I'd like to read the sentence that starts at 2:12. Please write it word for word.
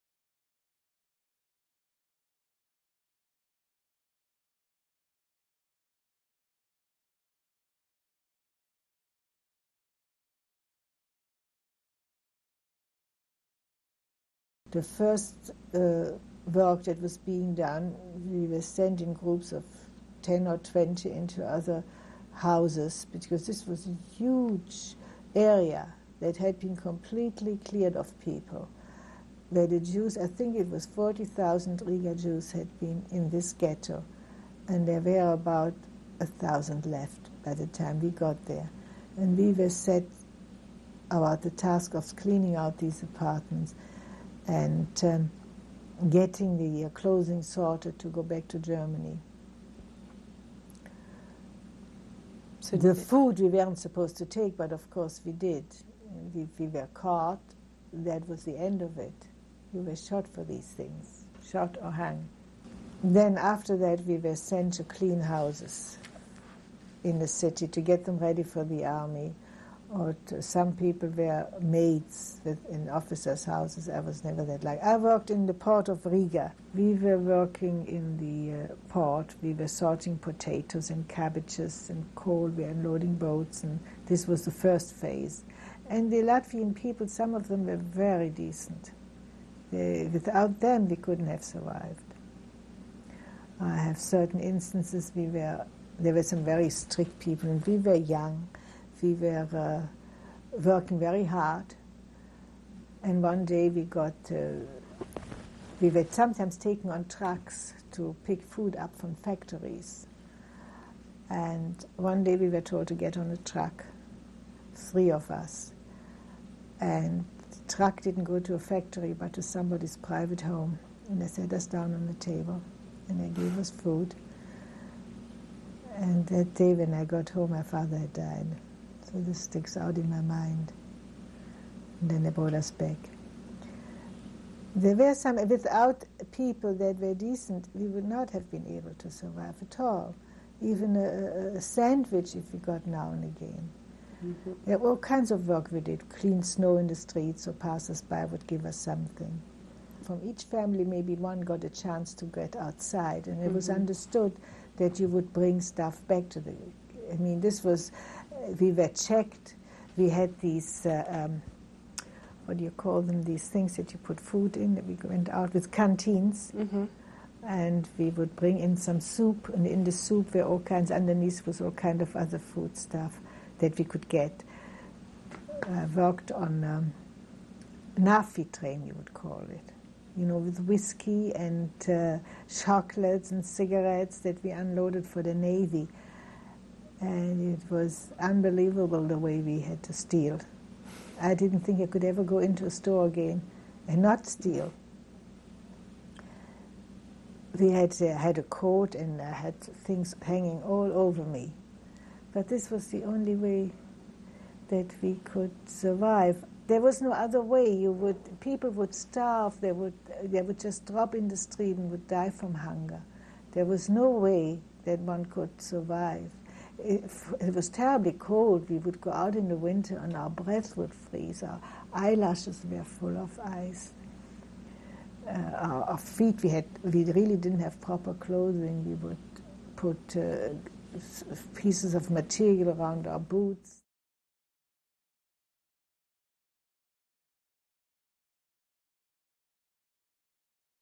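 And then they brought us back.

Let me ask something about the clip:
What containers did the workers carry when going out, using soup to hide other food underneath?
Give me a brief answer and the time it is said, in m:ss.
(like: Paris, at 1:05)
canteens, at 2:45.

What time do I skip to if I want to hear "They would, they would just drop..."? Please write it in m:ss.
3:29.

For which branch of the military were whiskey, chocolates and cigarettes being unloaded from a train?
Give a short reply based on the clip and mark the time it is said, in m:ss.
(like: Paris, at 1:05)
the Navy, at 3:05.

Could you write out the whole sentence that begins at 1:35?
We were there were some very strict people, and we were young we were uh, working very hard.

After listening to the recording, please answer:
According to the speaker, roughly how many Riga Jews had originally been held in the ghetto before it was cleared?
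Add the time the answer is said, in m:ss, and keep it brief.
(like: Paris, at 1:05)
40,000, at 0:30.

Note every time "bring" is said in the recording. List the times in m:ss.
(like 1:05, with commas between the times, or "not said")
2:35, 2:48.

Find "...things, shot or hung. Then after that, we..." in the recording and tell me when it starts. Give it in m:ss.
1:00.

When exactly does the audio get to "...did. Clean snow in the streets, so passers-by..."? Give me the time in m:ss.
2:25.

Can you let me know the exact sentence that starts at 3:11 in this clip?
I didn't think I could ever go into a store again and not steal.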